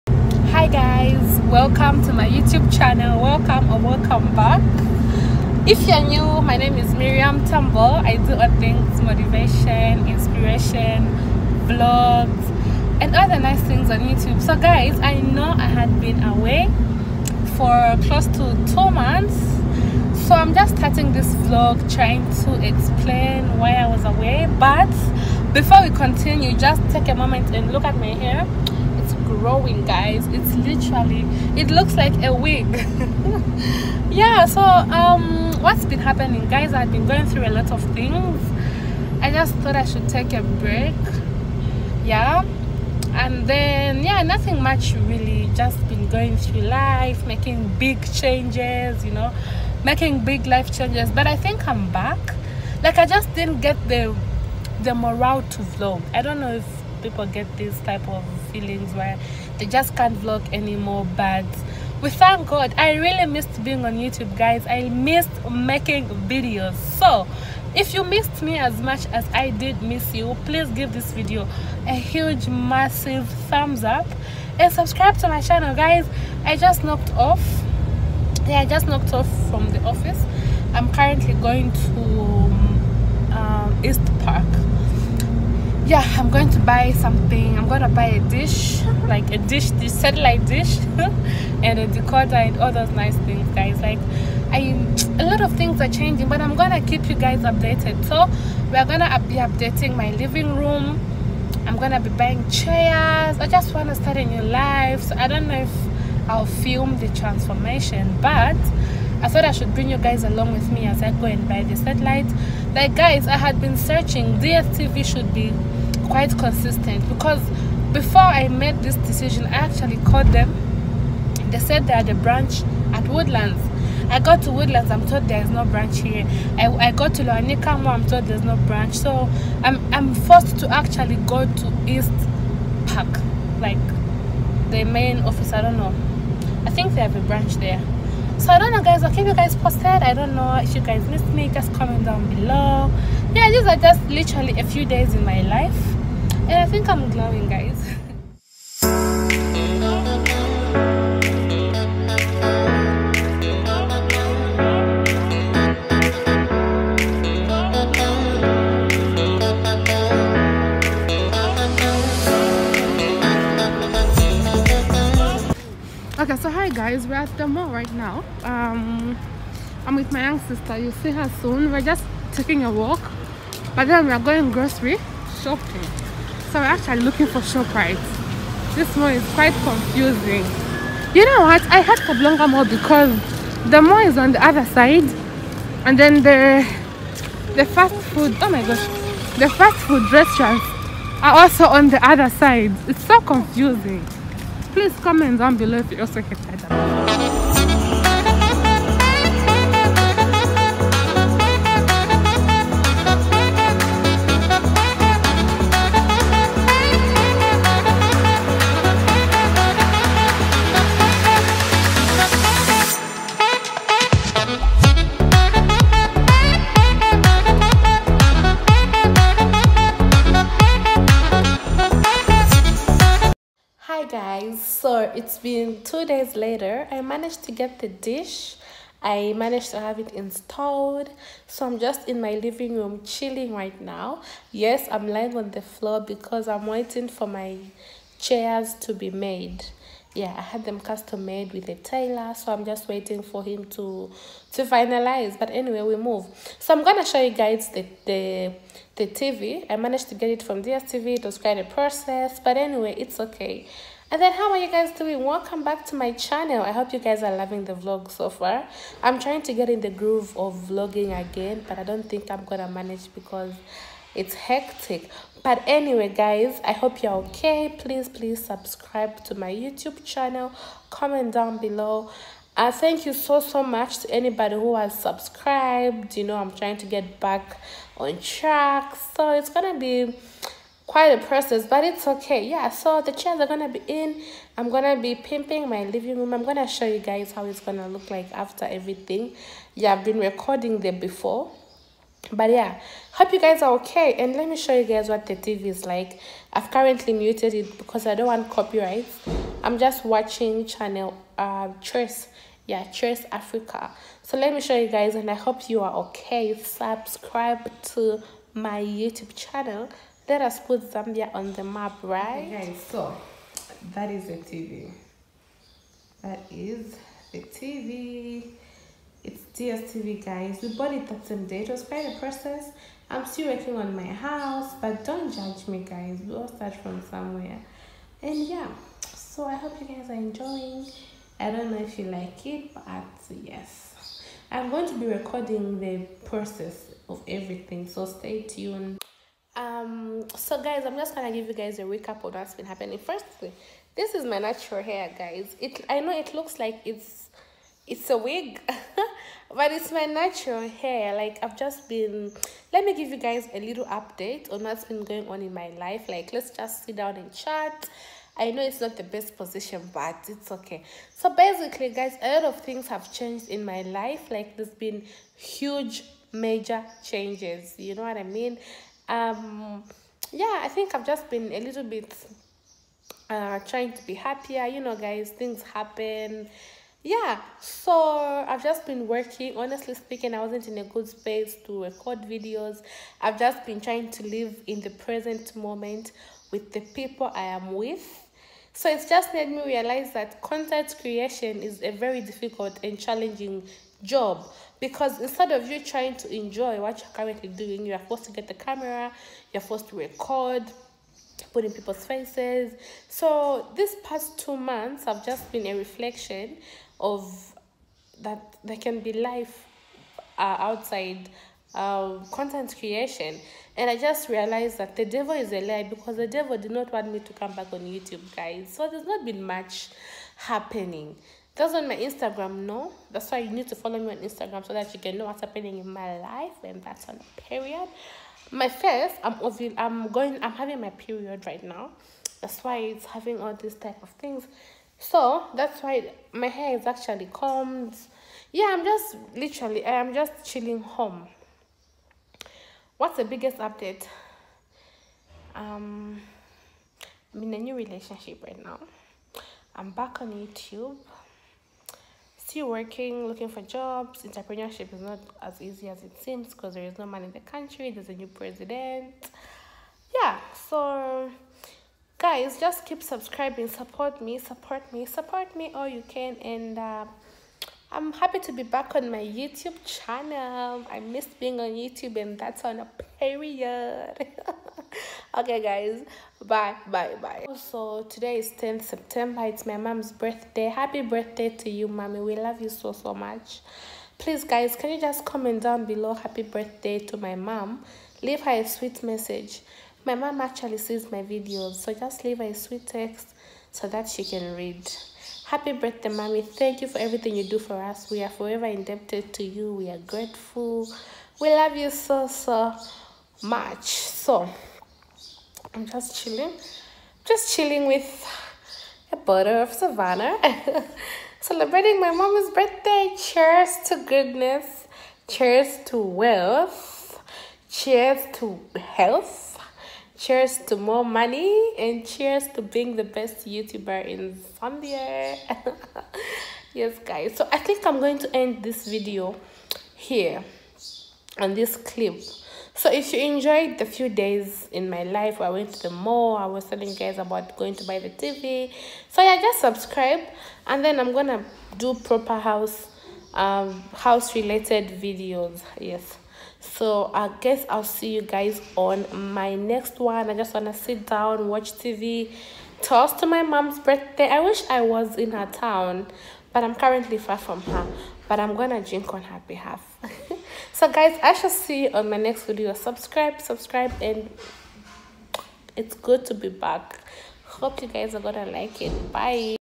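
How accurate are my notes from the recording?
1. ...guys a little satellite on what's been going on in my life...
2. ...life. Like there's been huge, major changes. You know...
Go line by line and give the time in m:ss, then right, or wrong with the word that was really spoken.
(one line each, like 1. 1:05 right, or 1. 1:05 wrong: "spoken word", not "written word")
1. 5:53 wrong: "update", not "satellite"
2. 6:03 right.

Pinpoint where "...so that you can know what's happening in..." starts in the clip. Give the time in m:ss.
7:04.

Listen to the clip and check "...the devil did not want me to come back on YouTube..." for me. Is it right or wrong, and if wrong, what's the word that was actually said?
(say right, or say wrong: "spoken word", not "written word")
right.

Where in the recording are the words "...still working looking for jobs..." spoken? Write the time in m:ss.
7:32.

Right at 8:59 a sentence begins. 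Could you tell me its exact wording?
So yeah, just subscribe and then I'm gonna do proper house um house related videos.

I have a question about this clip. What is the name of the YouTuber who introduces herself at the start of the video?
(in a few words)
Mirriam Tamboh.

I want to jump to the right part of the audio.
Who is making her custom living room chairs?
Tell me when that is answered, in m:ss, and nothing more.
4:01.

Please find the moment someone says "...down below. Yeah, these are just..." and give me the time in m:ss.
2:22.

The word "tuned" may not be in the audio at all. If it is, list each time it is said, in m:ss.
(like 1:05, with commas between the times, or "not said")
5:38.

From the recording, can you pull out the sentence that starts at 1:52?
Like guys, I had been searching.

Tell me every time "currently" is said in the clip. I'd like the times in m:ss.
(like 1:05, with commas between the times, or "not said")
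1:20, 4:56, 6:37, 9:16.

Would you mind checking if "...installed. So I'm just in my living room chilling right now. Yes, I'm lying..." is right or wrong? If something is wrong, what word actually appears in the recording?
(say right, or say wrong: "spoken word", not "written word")
right.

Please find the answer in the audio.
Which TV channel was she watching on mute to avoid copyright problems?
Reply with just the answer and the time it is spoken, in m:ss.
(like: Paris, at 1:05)
Choice Africa, at 5:02.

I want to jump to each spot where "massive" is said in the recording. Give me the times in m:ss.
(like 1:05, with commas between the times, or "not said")
1:12.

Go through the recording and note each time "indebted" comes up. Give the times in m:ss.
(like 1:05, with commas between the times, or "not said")
8:18.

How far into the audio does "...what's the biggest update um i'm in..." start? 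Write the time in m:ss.
7:23.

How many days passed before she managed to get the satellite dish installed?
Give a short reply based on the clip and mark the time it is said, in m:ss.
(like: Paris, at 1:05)
2, at 3:45.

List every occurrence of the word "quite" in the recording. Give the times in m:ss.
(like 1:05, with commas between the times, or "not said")
1:56, 2:59, 4:11, 4:40, 5:21.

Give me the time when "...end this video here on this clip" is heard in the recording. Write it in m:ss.
8:48.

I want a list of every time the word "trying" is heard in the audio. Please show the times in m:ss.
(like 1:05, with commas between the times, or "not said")
0:21, 4:19, 4:36, 6:13, 6:23, 6:35.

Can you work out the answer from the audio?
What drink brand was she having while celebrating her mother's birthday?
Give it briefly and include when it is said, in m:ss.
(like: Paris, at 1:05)
Savannah, at 8:29.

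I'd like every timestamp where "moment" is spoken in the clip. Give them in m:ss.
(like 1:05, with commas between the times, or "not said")
0:27, 6:25.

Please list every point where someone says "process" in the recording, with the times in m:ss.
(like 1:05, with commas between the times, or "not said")
4:11, 4:41, 5:22, 5:36.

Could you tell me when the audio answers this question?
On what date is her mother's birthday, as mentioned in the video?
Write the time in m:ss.
7:58.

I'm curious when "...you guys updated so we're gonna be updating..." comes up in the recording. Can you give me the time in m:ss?
1:37.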